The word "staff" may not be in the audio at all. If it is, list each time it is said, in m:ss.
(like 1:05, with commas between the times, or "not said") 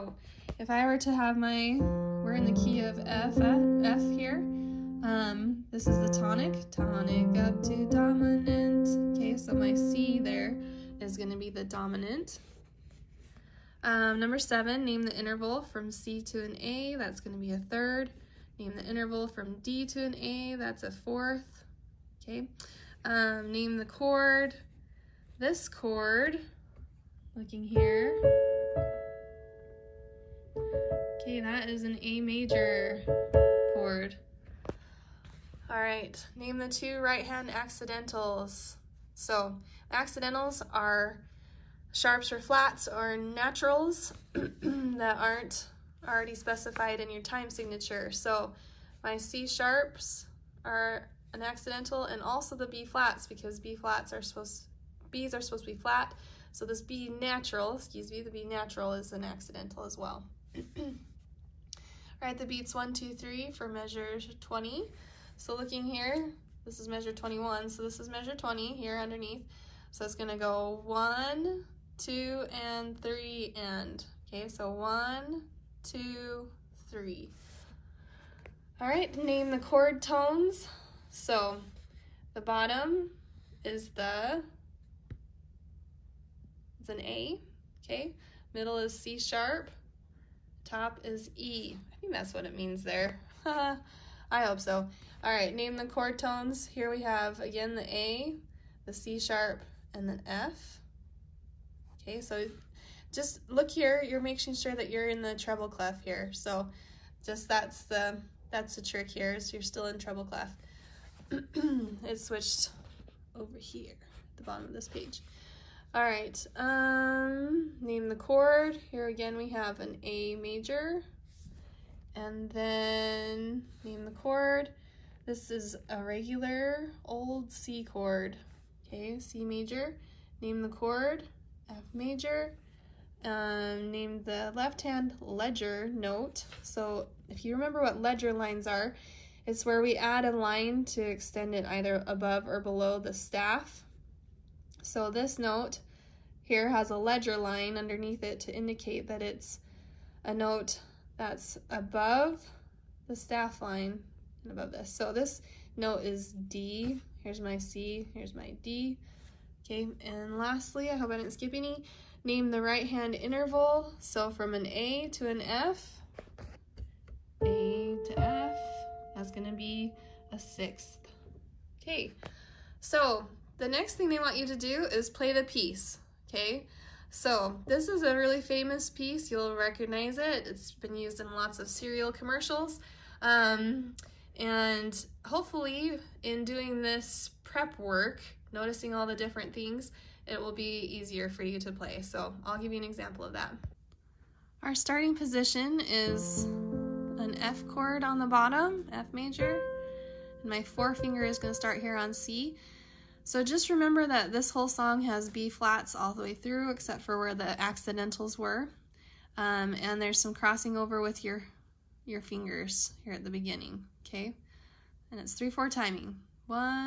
2:23, 2:33.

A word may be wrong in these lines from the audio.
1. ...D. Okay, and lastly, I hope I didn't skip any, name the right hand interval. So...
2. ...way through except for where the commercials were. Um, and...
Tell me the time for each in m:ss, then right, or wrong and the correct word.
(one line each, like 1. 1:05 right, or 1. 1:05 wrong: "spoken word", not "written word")
1. 2:38 right
2. 3:26 wrong: "accidentals", not "commercials".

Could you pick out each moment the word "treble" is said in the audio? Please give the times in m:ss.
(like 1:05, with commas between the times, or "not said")
1:45, 1:49.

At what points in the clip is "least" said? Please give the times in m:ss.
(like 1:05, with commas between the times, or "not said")
not said.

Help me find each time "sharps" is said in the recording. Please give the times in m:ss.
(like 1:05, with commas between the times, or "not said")
0:41, 0:49, 1:29, 1:39.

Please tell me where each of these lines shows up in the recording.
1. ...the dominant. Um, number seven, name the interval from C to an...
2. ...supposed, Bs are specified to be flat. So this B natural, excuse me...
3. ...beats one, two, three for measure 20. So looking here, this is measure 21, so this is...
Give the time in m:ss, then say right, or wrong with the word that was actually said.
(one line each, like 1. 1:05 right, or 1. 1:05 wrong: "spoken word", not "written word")
1. 0:11 right
2. 0:54 wrong: "supposed", not "specified"
3. 1:02 right.